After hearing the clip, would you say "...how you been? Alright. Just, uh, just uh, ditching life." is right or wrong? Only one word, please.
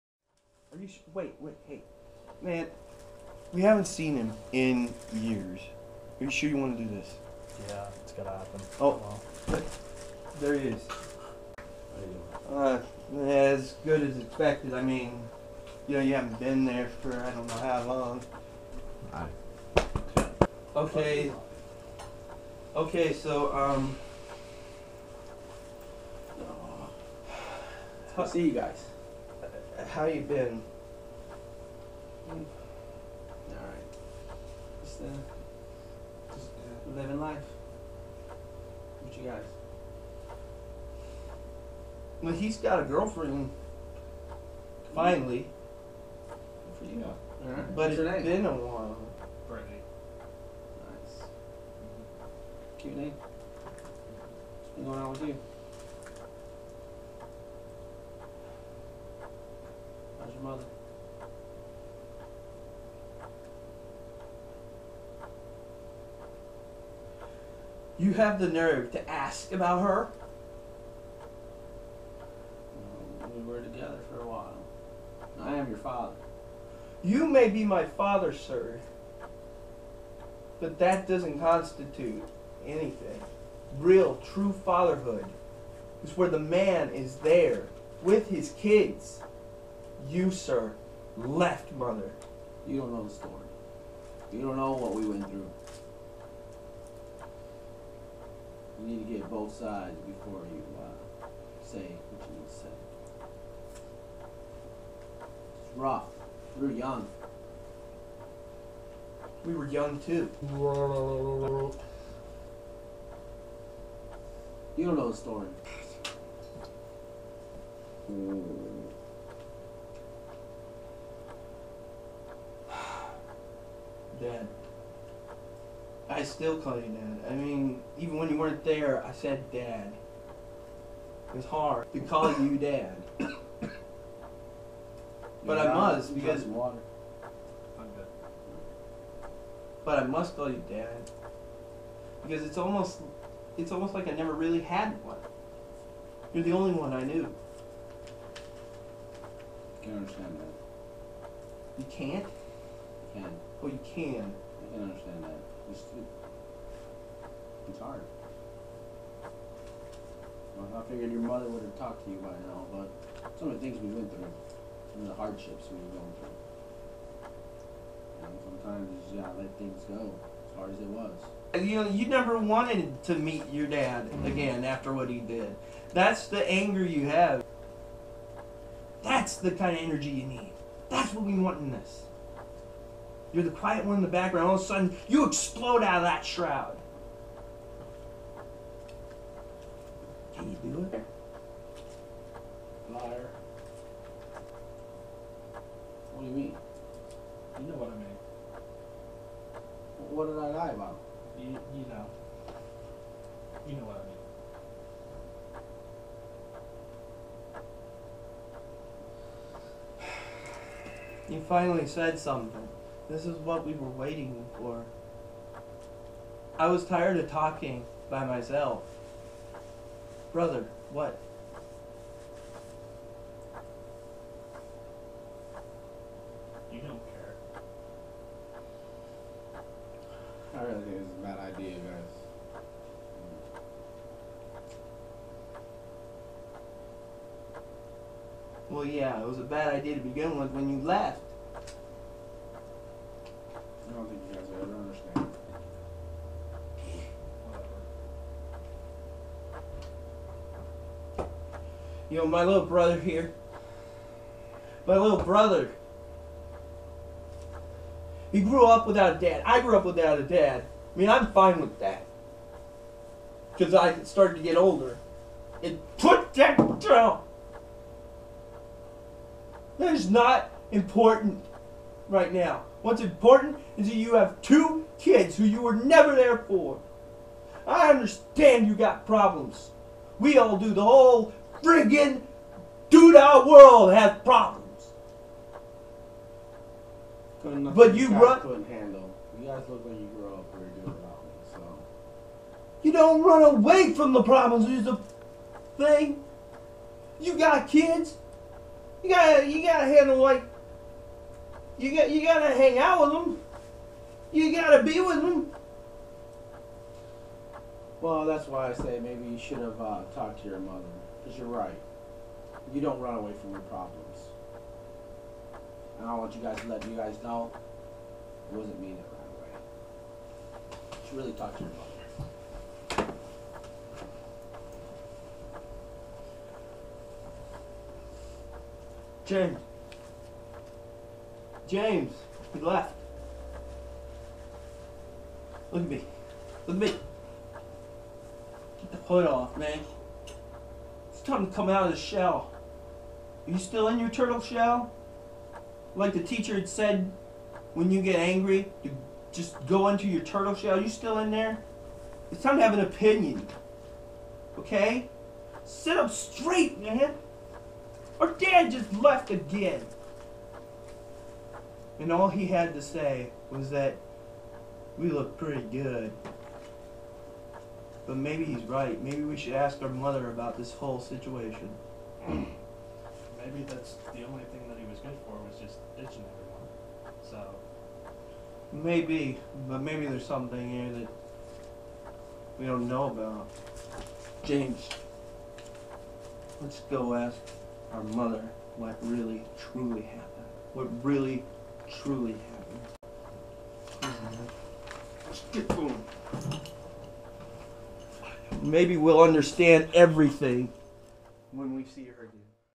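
wrong.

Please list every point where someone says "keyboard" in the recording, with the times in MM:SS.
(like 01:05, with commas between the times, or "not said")
not said.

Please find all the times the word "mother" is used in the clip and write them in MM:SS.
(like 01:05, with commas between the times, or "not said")
01:31, 02:41, 05:10, 05:21, 06:09, 06:28.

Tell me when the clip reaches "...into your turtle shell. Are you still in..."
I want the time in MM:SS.
05:49.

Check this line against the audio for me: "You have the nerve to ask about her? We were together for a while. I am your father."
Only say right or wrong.
right.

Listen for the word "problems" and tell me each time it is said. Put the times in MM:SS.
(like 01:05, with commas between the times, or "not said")
04:39, 04:44, 04:54, 05:13.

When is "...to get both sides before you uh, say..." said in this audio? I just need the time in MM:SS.
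01:39.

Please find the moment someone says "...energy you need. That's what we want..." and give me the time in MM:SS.
02:59.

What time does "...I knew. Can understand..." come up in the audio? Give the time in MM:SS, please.
02:26.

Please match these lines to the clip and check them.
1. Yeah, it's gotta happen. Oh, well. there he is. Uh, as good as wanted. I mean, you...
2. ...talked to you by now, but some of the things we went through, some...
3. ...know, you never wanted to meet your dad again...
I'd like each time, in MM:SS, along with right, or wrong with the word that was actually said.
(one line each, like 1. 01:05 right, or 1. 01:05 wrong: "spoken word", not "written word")
1. 00:07 wrong: "expected", not "wanted"
2. 02:41 right
3. 02:51 right.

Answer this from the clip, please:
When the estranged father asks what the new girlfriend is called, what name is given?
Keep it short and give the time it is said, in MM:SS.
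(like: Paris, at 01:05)
Brittany, at 00:49.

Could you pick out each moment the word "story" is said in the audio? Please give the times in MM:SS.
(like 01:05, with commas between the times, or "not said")
01:33, 01:55.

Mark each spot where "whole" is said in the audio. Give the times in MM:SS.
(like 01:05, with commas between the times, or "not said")
04:40, 06:10.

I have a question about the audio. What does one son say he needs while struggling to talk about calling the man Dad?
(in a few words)
water.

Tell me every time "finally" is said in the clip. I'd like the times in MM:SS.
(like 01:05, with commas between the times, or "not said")
00:44, 03:31.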